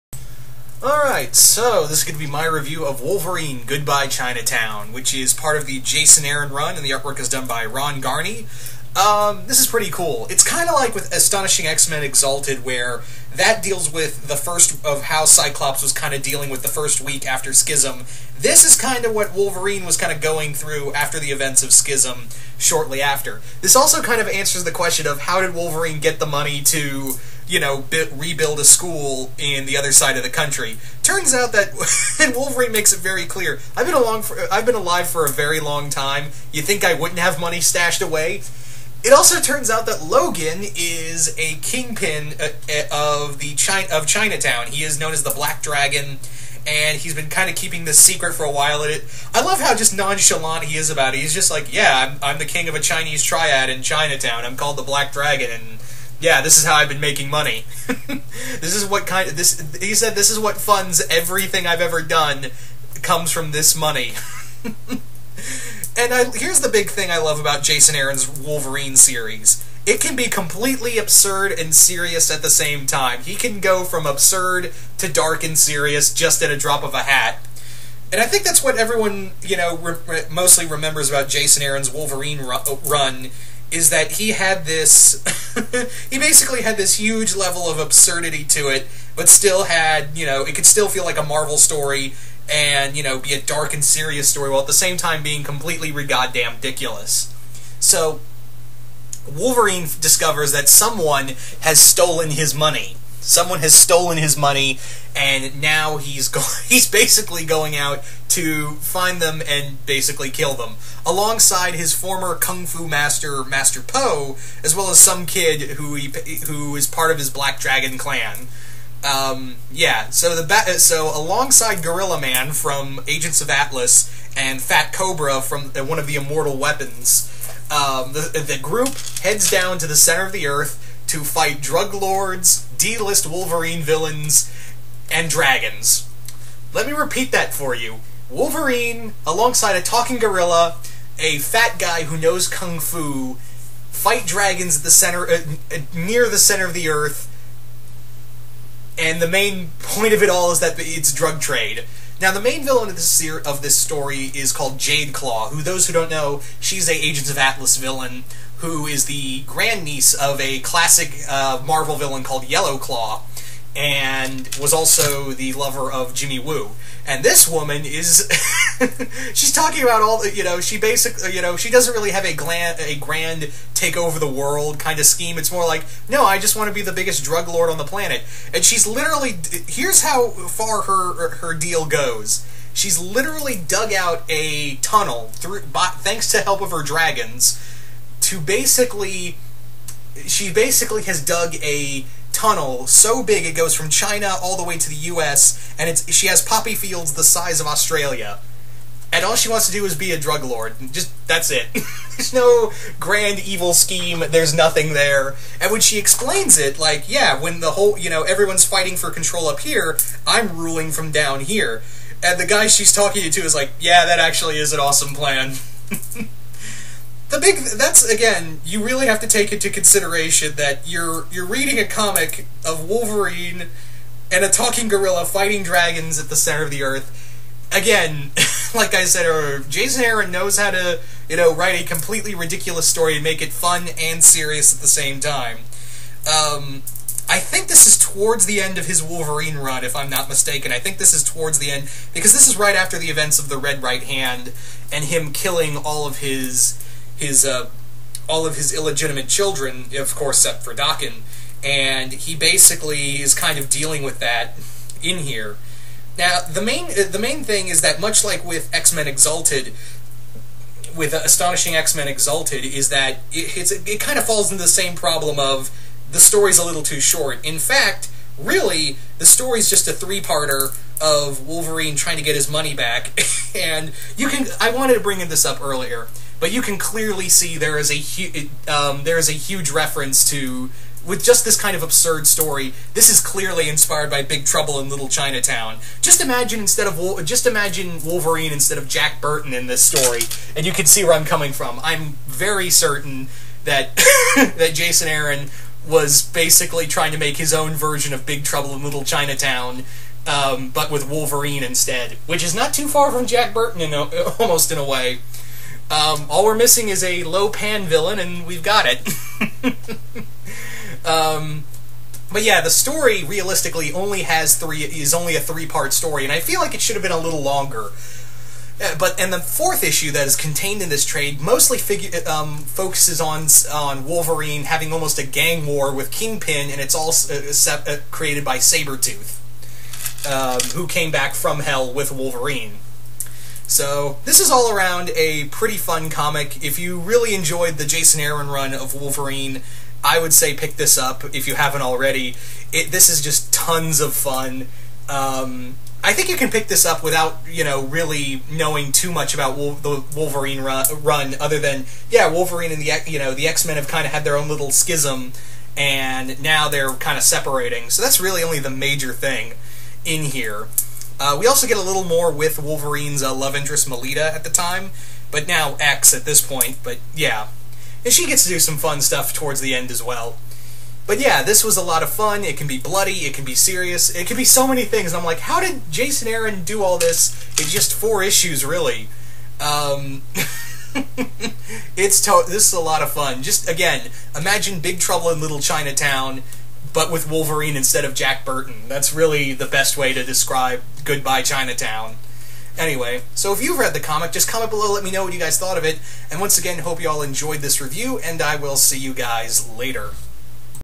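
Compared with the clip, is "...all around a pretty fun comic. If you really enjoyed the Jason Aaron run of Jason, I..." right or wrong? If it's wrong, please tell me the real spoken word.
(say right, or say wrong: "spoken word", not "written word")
wrong: "Wolverine", not "Jason".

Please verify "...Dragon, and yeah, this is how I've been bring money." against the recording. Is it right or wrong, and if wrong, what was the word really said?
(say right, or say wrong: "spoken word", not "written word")
wrong: "making", not "bring".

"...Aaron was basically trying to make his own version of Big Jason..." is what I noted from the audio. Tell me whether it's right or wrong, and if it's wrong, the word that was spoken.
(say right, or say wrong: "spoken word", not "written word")
wrong: "Trouble", not "Jason".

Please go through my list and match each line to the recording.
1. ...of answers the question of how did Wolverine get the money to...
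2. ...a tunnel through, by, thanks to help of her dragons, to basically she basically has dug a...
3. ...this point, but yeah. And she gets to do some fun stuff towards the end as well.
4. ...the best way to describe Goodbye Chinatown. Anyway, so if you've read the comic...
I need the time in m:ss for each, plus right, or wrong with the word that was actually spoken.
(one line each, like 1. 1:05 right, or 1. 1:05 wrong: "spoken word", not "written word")
1. 0:24 right
2. 3:04 right
3. 6:06 right
4. 6:29 right.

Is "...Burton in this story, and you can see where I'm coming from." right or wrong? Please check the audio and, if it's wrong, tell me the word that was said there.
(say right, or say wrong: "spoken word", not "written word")
right.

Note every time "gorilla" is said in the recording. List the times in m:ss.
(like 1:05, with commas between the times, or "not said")
2:01, 2:20, 3:44.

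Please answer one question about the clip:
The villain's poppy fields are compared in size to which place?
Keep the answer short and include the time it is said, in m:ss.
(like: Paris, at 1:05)
Australia, at 3:17.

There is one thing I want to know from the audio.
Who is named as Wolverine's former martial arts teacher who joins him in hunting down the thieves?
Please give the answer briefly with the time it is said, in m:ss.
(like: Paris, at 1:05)
Master Po, at 1:53.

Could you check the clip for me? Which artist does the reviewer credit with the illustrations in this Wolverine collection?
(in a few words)
Ron Garney.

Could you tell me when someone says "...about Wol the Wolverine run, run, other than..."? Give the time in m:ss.
5:49.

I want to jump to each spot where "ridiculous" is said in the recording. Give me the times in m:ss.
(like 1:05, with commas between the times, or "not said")
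1:36, 3:52.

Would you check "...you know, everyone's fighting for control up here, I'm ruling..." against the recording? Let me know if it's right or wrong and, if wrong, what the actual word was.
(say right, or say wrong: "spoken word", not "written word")
right.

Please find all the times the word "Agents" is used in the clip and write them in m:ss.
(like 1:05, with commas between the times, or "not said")
2:03, 2:36.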